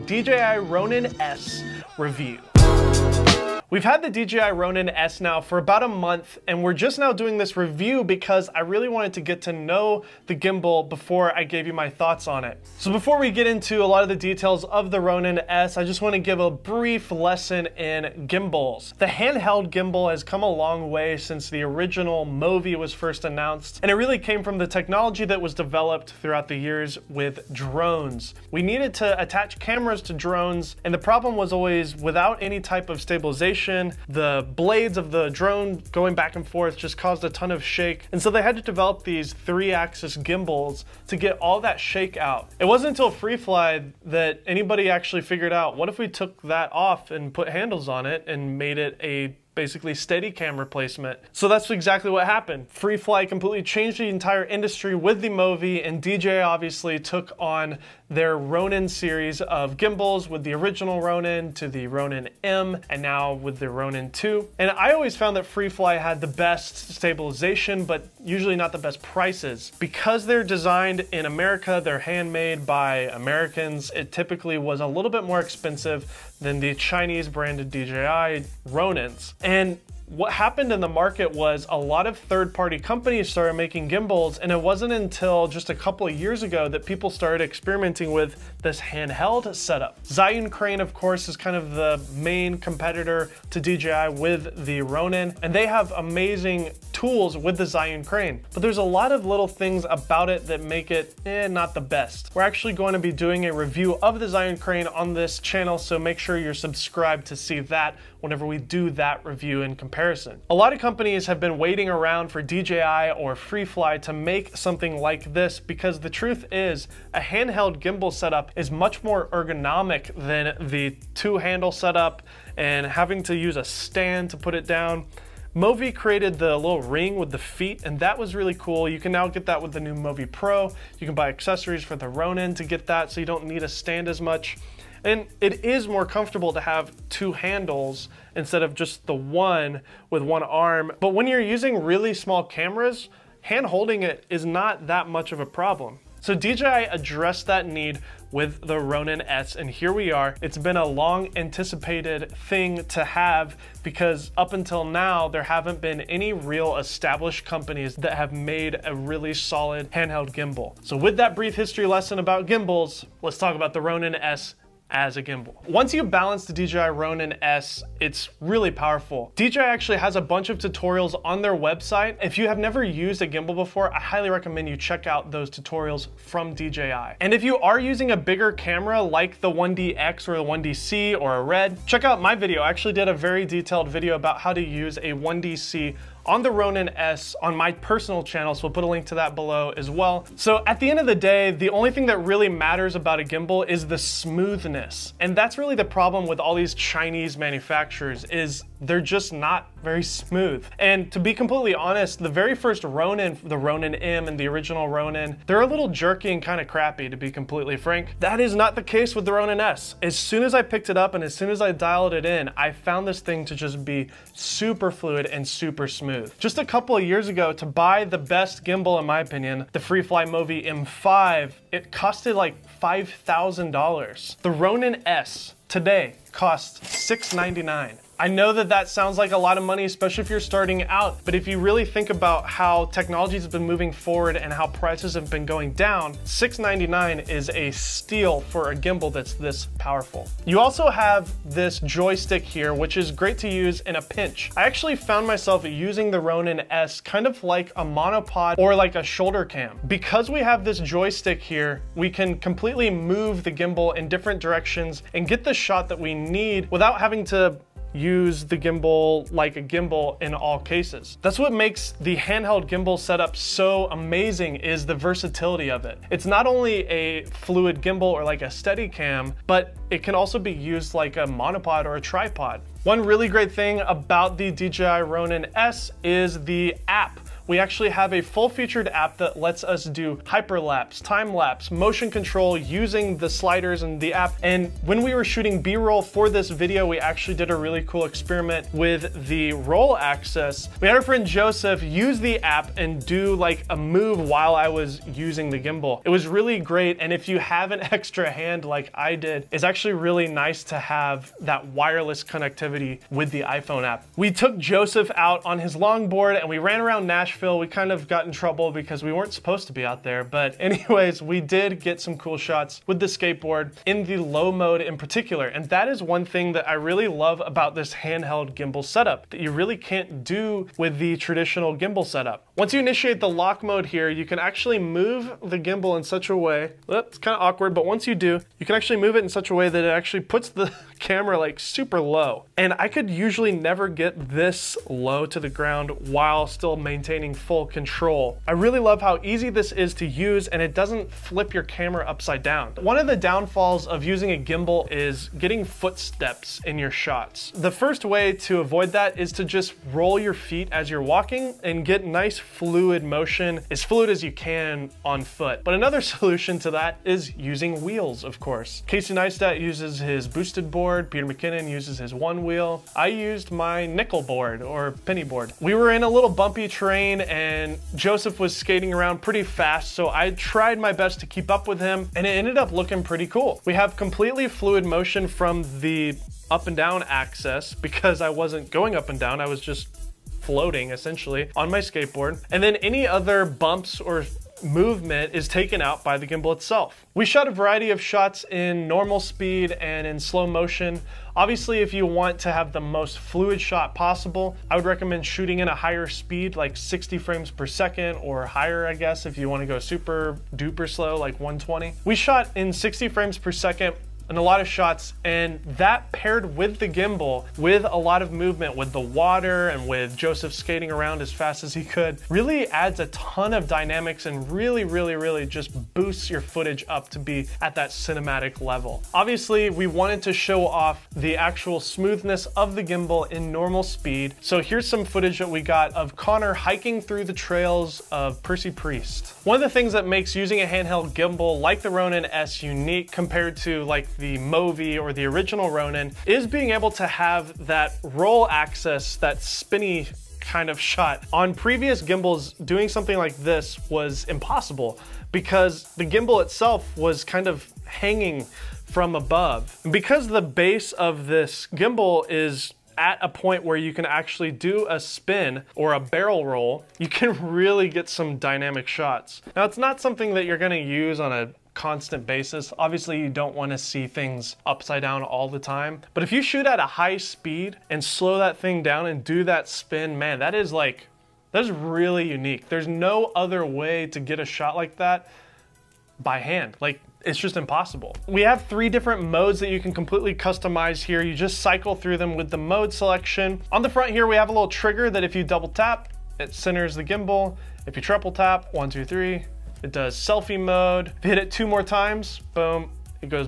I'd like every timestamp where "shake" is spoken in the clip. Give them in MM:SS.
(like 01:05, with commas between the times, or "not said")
00:37, 00:41.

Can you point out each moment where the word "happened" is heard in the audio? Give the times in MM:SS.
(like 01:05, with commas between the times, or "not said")
00:52, 01:20.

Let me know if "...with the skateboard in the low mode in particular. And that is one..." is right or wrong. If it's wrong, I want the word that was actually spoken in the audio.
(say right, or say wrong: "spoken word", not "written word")
right.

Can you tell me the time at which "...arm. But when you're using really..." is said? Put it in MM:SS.
02:20.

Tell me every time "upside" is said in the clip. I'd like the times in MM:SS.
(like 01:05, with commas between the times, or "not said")
05:42, 07:44.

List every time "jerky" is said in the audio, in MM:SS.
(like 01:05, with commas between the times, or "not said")
03:25.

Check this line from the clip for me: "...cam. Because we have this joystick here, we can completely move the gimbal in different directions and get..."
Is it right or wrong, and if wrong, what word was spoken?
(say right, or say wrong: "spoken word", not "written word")
right.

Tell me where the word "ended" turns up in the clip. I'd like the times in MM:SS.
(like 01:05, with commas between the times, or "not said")
06:12.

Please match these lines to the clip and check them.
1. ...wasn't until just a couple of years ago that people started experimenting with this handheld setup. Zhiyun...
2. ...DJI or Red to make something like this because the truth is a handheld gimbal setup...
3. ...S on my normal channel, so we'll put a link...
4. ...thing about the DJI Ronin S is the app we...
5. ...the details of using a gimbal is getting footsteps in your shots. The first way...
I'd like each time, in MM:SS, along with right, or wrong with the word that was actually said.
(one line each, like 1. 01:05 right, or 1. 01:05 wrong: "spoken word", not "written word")
1. 01:24 right
2. 01:52 wrong: "FreeFly", not "Red"
3. 03:06 wrong: "personal", not "normal"
4. 04:33 right
5. 05:43 wrong: "downfalls", not "details".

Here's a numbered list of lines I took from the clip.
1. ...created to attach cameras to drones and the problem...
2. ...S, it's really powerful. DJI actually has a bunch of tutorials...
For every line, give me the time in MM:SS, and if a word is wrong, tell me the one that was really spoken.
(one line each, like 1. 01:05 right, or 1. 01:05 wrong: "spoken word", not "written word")
1. 00:28 wrong: "needed", not "created"
2. 02:47 right.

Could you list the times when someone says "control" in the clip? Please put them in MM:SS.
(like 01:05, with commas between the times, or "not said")
04:42, 05:37.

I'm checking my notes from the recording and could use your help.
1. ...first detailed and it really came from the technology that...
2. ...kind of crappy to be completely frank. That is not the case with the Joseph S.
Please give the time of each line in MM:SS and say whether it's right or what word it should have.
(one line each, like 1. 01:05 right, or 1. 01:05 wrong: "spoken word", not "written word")
1. 00:22 wrong: "announced", not "detailed"
2. 03:26 wrong: "Ronin", not "Joseph".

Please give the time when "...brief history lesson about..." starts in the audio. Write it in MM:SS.
02:41.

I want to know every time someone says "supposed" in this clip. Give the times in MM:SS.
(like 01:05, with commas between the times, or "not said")
05:09.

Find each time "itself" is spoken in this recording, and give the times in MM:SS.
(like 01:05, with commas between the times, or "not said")
06:26, 07:26.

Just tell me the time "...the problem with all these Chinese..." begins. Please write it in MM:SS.
03:15.